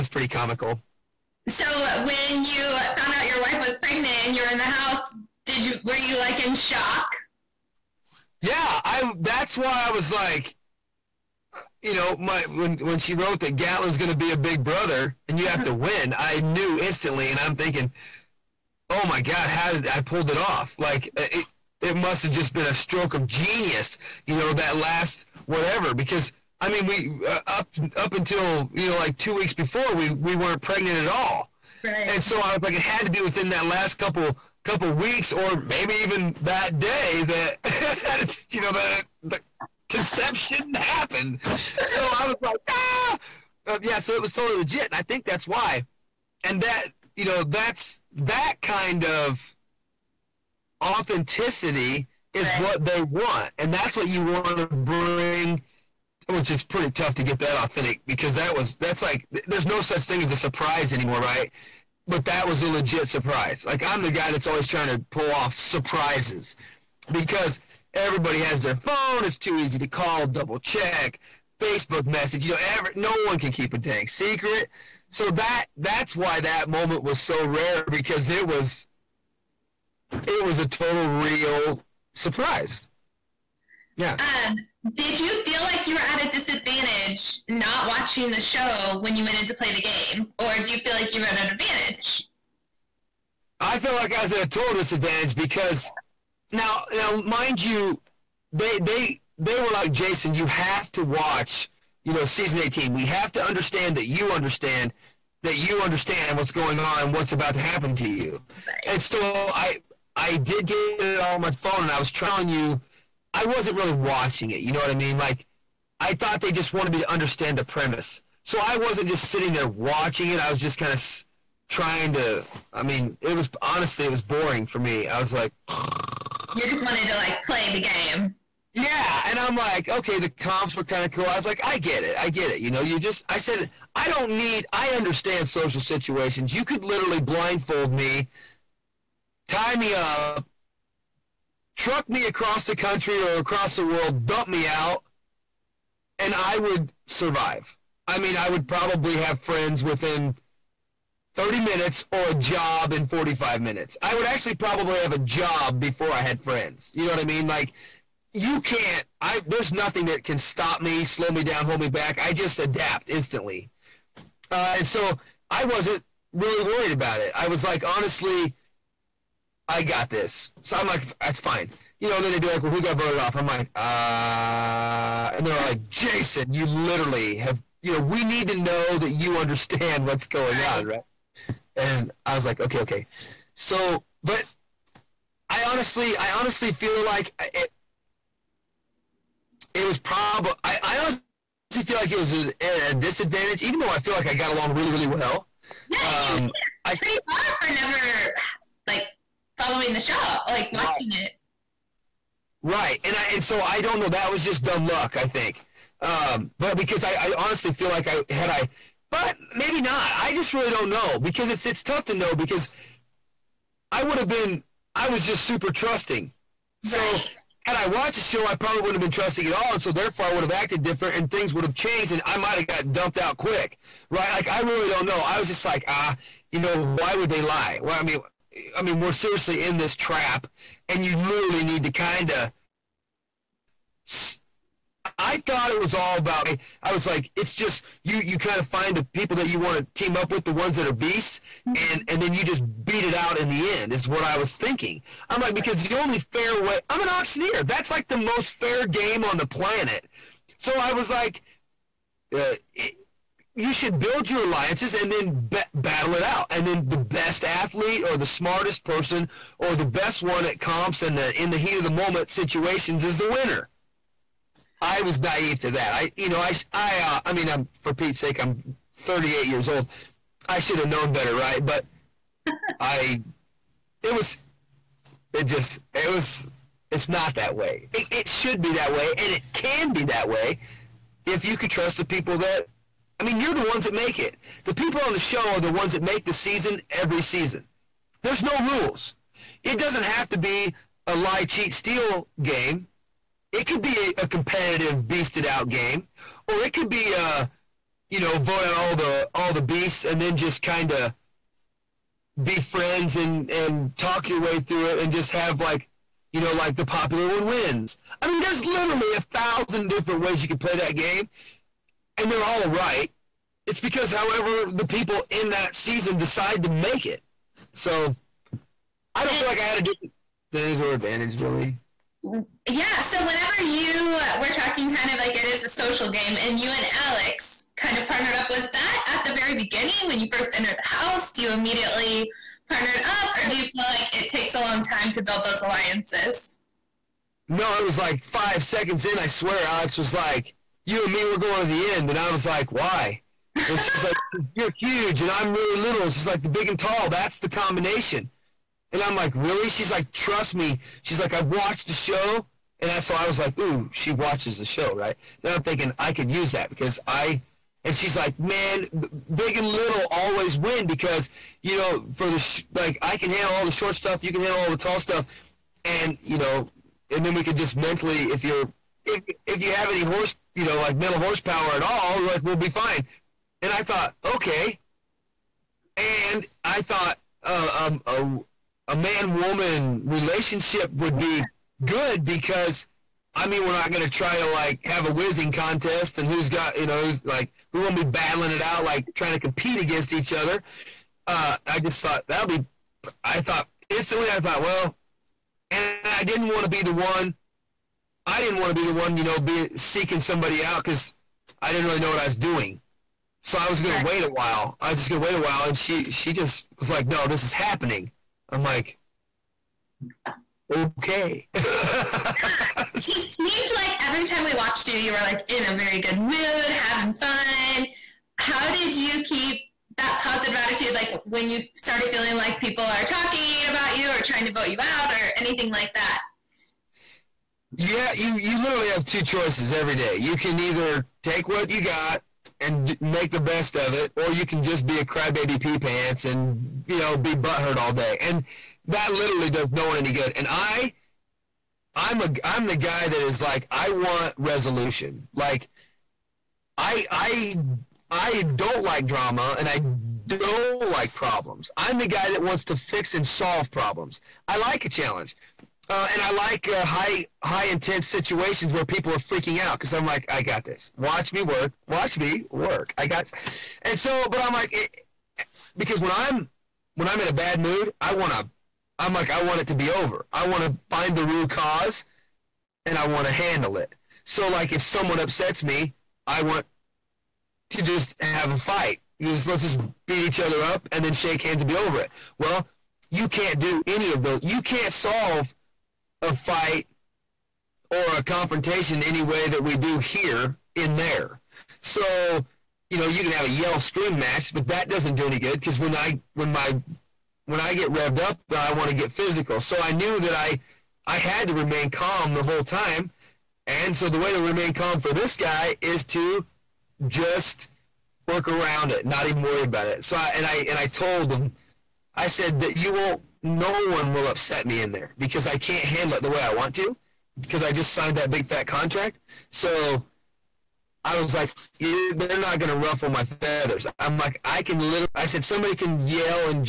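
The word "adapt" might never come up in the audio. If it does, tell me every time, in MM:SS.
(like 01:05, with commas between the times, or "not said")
02:42.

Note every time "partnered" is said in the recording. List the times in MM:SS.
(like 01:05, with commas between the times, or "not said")
05:28, 05:32.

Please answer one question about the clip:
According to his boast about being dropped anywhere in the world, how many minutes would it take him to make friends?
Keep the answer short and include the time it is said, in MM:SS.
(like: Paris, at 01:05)
30, at 02:31.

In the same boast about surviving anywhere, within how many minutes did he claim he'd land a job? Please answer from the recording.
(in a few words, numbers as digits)
45.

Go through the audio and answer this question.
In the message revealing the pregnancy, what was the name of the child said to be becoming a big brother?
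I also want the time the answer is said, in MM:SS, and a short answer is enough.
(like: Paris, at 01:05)
Gatlin, at 00:13.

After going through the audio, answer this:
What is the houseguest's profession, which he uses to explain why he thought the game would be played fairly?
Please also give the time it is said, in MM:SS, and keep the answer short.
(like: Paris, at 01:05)
Auctioneer, at 04:07.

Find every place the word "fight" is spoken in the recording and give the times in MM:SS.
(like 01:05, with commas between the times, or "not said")
07:58, 08:06.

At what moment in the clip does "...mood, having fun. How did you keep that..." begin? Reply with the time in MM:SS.
06:56.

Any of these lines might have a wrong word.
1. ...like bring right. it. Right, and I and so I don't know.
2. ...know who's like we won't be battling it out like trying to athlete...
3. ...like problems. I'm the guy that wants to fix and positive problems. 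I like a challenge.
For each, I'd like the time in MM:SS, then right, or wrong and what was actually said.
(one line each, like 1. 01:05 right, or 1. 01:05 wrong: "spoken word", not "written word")
1. 03:20 wrong: "watching", not "bring"
2. 06:26 wrong: "compete", not "athlete"
3. 07:30 wrong: "solve", not "positive".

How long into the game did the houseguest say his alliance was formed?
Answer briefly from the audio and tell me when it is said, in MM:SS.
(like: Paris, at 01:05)
5 seconds, at 05:38.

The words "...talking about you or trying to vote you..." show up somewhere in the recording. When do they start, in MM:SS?
07:03.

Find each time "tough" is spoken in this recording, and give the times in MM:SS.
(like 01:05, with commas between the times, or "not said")
00:56, 03:31.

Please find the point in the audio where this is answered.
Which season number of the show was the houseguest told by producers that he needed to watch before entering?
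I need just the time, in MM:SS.
01:42.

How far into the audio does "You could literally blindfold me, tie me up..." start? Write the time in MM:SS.
02:16.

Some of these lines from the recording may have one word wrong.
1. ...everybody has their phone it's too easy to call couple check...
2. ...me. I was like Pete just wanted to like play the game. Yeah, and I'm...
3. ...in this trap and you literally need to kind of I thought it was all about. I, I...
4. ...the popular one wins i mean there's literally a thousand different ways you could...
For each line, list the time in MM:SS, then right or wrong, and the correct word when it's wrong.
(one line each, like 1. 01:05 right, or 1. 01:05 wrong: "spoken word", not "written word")
1. 01:07 wrong: "double", not "couple"
2. 02:04 wrong: "You", not "Pete"
3. 03:49 right
4. 05:06 right.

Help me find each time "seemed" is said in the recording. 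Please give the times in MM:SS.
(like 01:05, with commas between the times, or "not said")
06:53.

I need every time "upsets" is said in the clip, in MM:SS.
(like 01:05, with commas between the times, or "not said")
07:55, 08:34.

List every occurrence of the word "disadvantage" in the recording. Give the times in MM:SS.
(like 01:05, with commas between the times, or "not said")
01:26, 01:34, 03:12, 05:20.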